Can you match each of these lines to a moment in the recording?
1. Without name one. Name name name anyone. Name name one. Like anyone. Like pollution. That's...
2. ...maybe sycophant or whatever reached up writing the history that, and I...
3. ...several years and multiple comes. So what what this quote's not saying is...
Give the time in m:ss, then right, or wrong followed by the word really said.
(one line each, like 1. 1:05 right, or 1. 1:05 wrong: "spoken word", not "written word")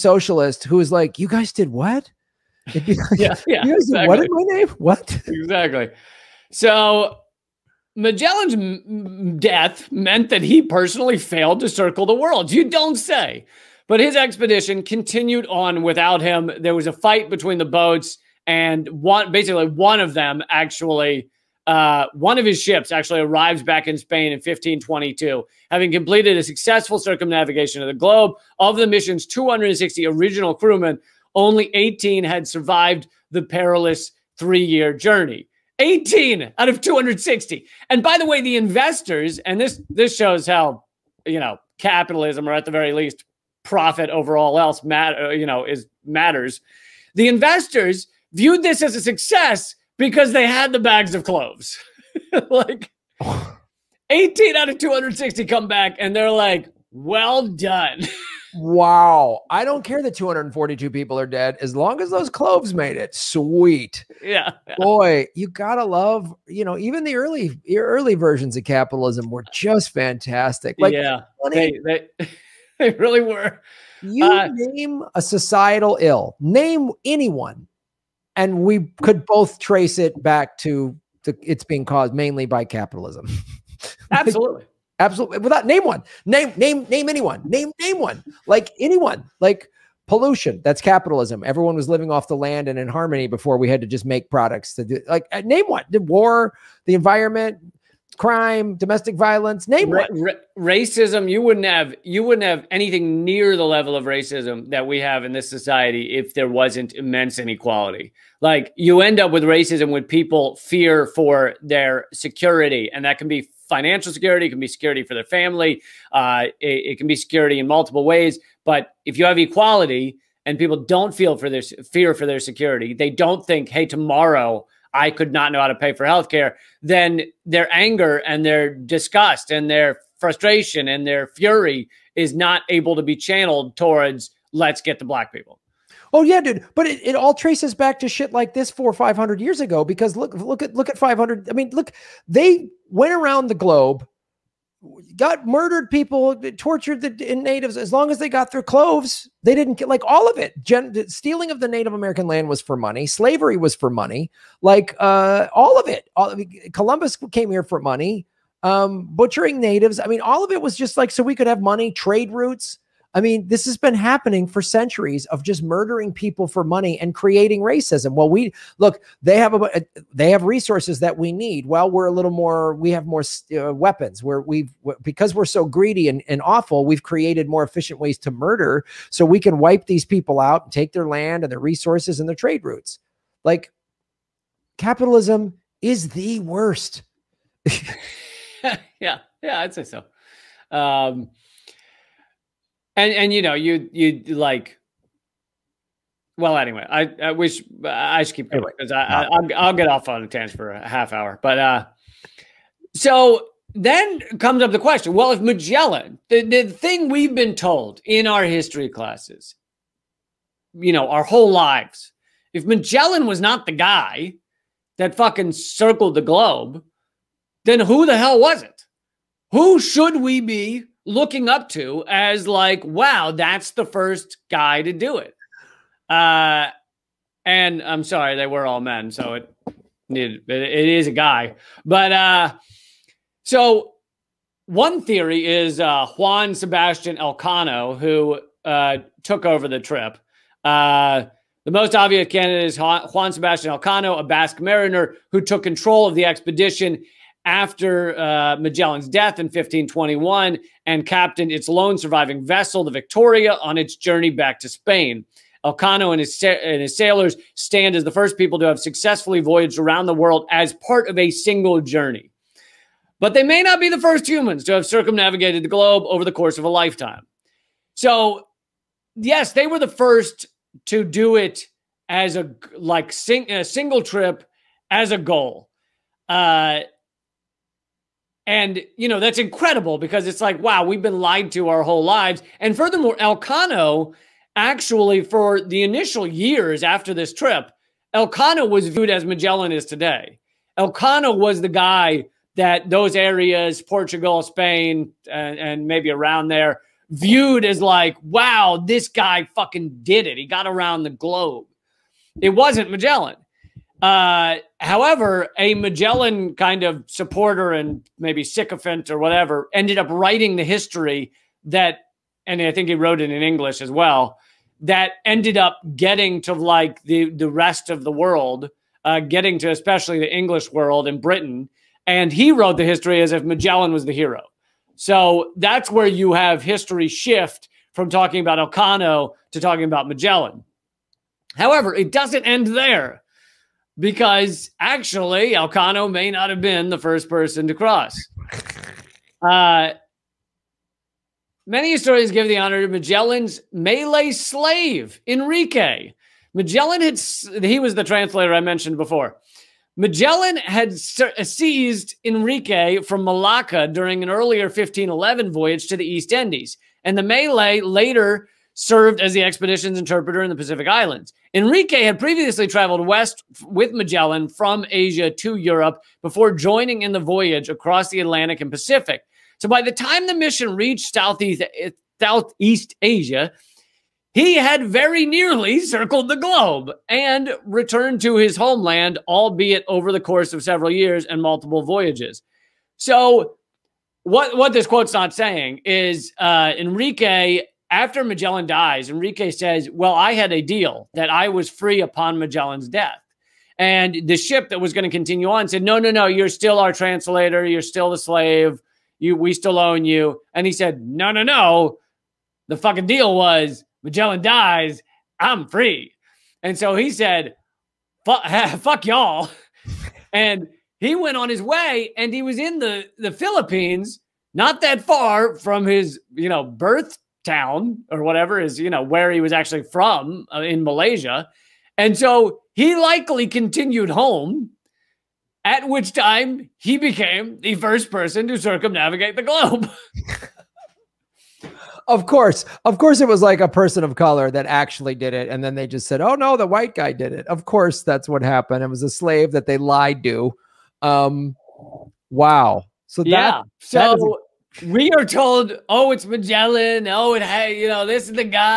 1. 1:25 right
2. 5:08 wrong: "ended", not "reached"
3. 6:20 wrong: "voyages", not "comes".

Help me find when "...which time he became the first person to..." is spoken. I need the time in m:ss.
7:05.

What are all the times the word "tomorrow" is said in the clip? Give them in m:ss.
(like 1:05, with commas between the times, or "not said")
2:03.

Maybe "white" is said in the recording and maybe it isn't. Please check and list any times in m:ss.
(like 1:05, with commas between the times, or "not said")
7:16.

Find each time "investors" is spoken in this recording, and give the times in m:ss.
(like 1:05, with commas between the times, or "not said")
0:38, 0:47.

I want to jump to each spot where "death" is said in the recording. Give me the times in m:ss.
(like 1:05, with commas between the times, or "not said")
0:09, 4:09, 6:32.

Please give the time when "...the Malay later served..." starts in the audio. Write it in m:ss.
5:57.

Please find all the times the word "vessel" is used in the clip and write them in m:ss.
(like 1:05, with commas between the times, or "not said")
4:12.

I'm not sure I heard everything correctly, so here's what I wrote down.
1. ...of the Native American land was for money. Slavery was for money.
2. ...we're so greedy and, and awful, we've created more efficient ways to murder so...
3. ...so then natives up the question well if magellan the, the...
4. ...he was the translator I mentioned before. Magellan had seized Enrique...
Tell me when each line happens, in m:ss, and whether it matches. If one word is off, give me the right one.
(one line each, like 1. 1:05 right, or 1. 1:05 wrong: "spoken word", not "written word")
1. 2:31 right
2. 2:55 right
3. 3:22 wrong: "comes", not "natives"
4. 5:47 right.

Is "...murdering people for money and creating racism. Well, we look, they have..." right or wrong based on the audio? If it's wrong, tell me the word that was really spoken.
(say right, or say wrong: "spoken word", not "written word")
right.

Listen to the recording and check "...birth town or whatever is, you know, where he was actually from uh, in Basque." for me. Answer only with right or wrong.
wrong.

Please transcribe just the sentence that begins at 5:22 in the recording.
And he wrote the history as if Magellan was the hero.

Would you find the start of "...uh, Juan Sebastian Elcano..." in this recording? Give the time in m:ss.
3:55.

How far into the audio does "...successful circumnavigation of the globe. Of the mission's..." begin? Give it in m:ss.
0:26.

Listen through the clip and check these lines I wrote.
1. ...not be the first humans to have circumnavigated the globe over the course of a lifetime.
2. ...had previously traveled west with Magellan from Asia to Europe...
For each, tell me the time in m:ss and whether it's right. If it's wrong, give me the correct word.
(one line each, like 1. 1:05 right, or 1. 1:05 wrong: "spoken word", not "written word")
1. 4:23 right
2. 6:02 right.